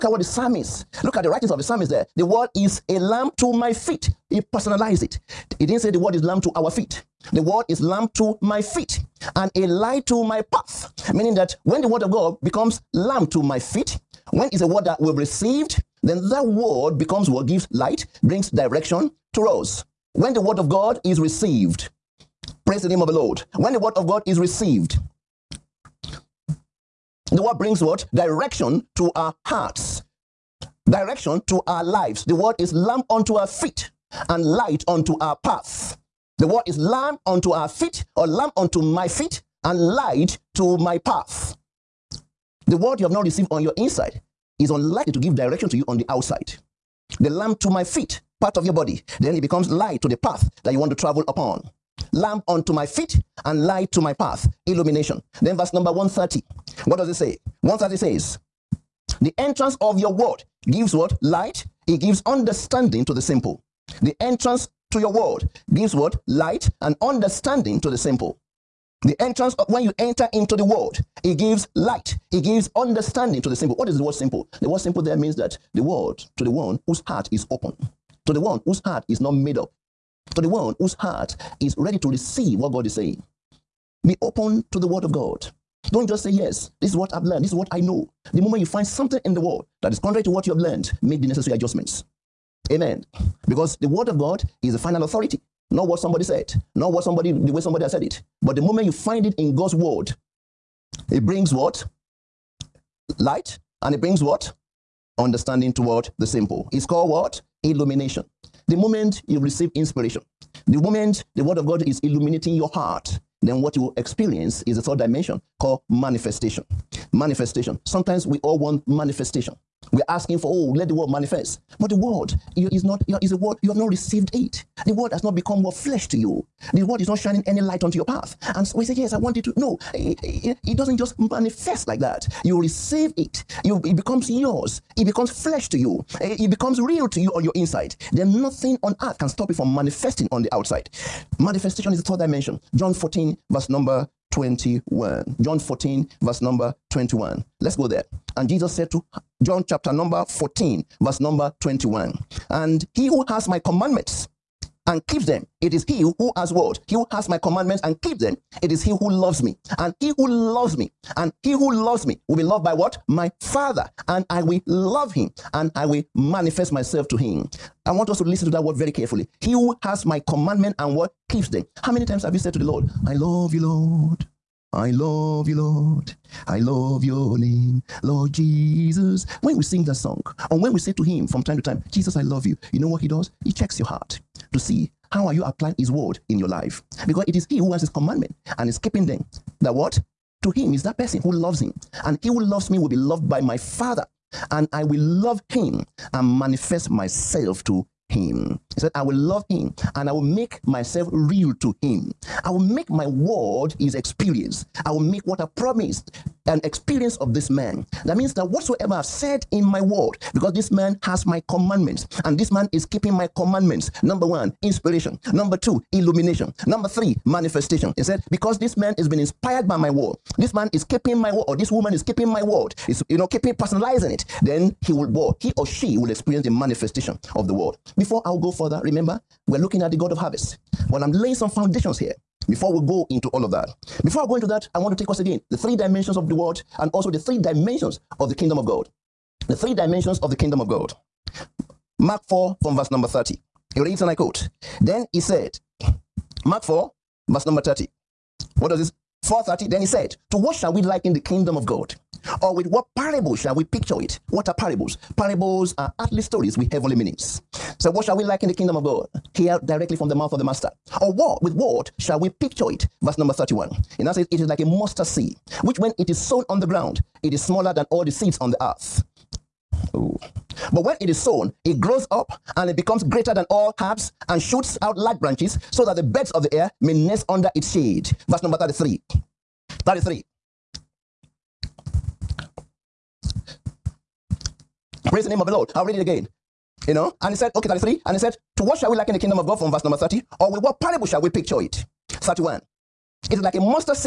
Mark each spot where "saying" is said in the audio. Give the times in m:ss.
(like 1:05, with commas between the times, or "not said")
1:22.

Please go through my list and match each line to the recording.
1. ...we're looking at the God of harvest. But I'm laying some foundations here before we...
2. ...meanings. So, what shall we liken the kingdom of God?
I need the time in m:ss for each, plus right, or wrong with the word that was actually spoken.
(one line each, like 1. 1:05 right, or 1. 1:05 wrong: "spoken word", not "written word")
1. 3:49 right
2. 4:16 right.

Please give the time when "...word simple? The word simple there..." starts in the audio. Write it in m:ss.
1:14.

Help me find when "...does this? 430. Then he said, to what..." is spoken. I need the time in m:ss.
4:08.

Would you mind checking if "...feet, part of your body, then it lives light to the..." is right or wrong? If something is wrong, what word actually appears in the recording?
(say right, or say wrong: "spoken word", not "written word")
wrong: "becomes", not "lives".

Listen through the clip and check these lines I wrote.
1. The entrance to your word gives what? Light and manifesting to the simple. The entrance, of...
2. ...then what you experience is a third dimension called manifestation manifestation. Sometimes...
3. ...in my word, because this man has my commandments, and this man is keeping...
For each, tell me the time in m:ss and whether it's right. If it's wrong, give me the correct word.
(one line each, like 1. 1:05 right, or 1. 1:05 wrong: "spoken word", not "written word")
1. 1:04 wrong: "understanding", not "manifesting"
2. 1:53 right
3. 3:29 right.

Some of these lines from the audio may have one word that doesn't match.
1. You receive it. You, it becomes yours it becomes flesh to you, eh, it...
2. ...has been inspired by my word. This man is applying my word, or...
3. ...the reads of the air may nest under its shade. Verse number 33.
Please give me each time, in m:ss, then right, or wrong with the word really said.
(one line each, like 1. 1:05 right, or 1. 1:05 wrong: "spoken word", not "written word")
1. 2:12 right
2. 3:38 wrong: "keeping", not "applying"
3. 4:35 wrong: "birds", not "reads".